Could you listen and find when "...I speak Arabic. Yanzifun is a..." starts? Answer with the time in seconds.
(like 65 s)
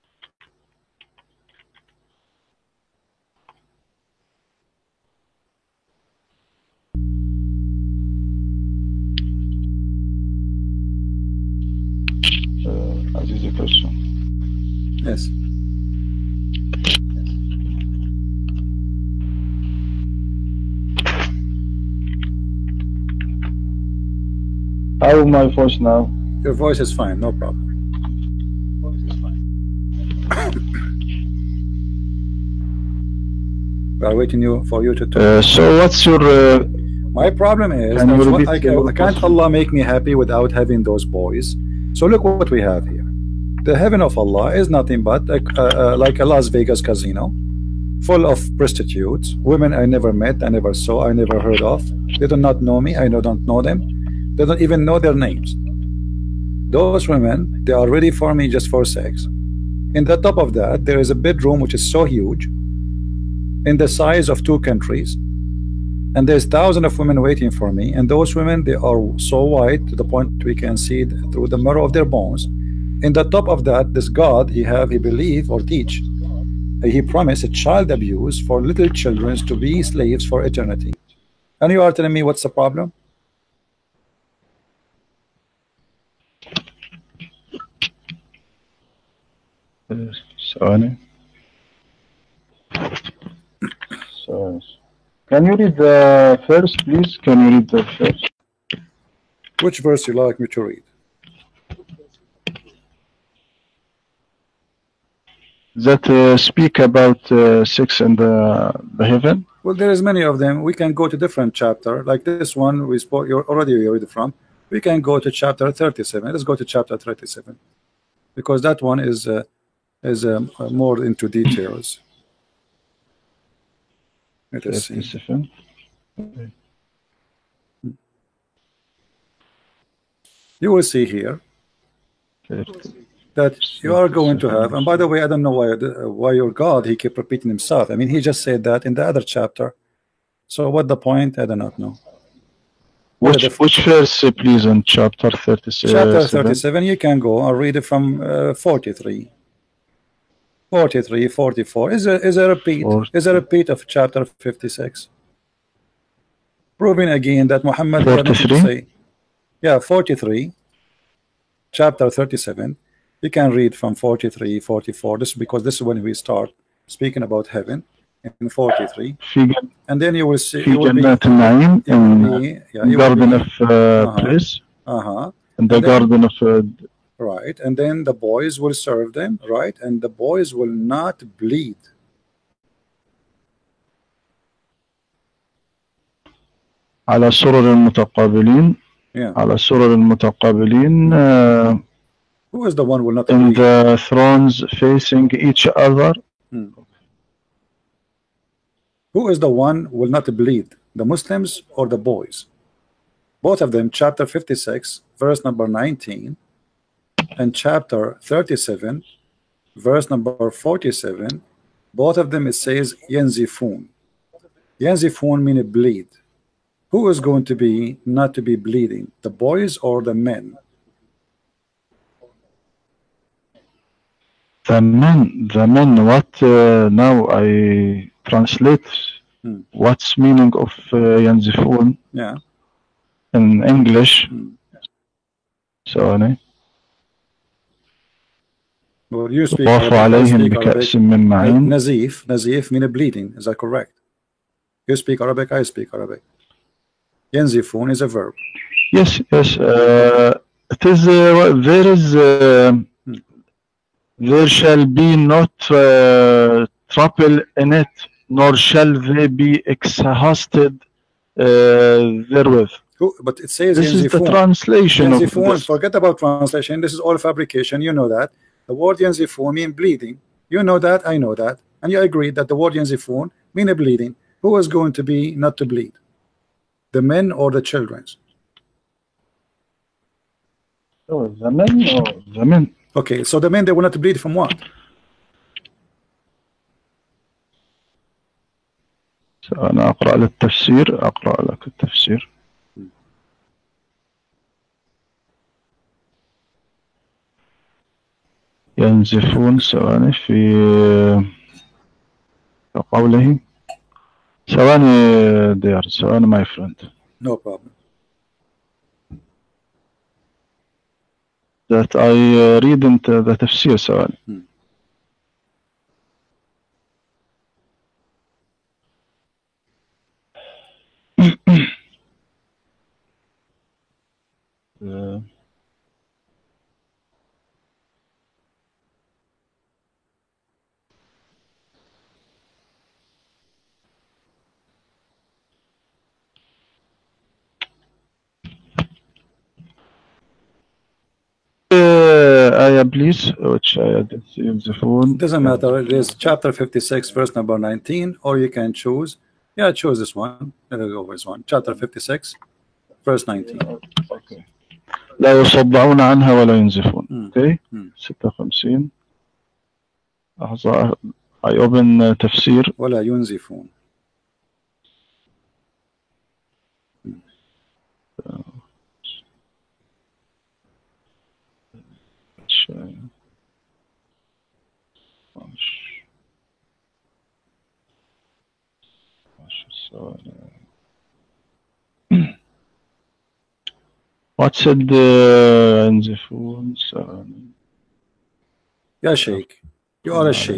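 245 s.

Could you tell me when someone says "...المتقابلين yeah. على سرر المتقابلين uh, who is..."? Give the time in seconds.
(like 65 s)
187 s.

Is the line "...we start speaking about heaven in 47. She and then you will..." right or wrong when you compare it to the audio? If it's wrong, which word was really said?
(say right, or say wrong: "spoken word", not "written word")
wrong: "43", not "47".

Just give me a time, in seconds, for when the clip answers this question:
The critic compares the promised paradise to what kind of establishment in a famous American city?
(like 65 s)
46 s.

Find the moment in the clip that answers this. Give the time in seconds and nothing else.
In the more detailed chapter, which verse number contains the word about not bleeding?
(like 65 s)
209 s.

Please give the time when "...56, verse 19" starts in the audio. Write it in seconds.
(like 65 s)
351 s.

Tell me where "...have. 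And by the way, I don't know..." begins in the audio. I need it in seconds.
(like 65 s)
134 s.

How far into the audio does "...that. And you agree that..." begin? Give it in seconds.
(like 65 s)
271 s.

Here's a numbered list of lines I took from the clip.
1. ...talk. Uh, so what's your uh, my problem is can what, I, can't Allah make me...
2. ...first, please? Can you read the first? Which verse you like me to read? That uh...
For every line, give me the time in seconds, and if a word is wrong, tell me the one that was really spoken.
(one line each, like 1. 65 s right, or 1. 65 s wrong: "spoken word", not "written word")
1. 35 s right
2. 96 s right.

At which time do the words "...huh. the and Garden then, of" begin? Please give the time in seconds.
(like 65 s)
175 s.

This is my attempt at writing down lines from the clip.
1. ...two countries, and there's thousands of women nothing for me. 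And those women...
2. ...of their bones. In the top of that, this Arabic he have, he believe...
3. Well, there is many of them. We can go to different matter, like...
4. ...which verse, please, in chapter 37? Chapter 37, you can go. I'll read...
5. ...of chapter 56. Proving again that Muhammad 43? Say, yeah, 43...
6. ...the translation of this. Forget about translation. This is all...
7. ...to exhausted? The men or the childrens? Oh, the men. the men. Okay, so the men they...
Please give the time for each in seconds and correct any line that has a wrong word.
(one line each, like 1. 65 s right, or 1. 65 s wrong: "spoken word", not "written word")
1. 64 s wrong: "waiting", not "nothing"
2. 71 s wrong: "God", not "Arabic"
3. 109 s wrong: "chapter", not "matter"
4. 143 s right
5. 153 s right
6. 264 s right
7. 275 s wrong: "bleed", not "exhausted".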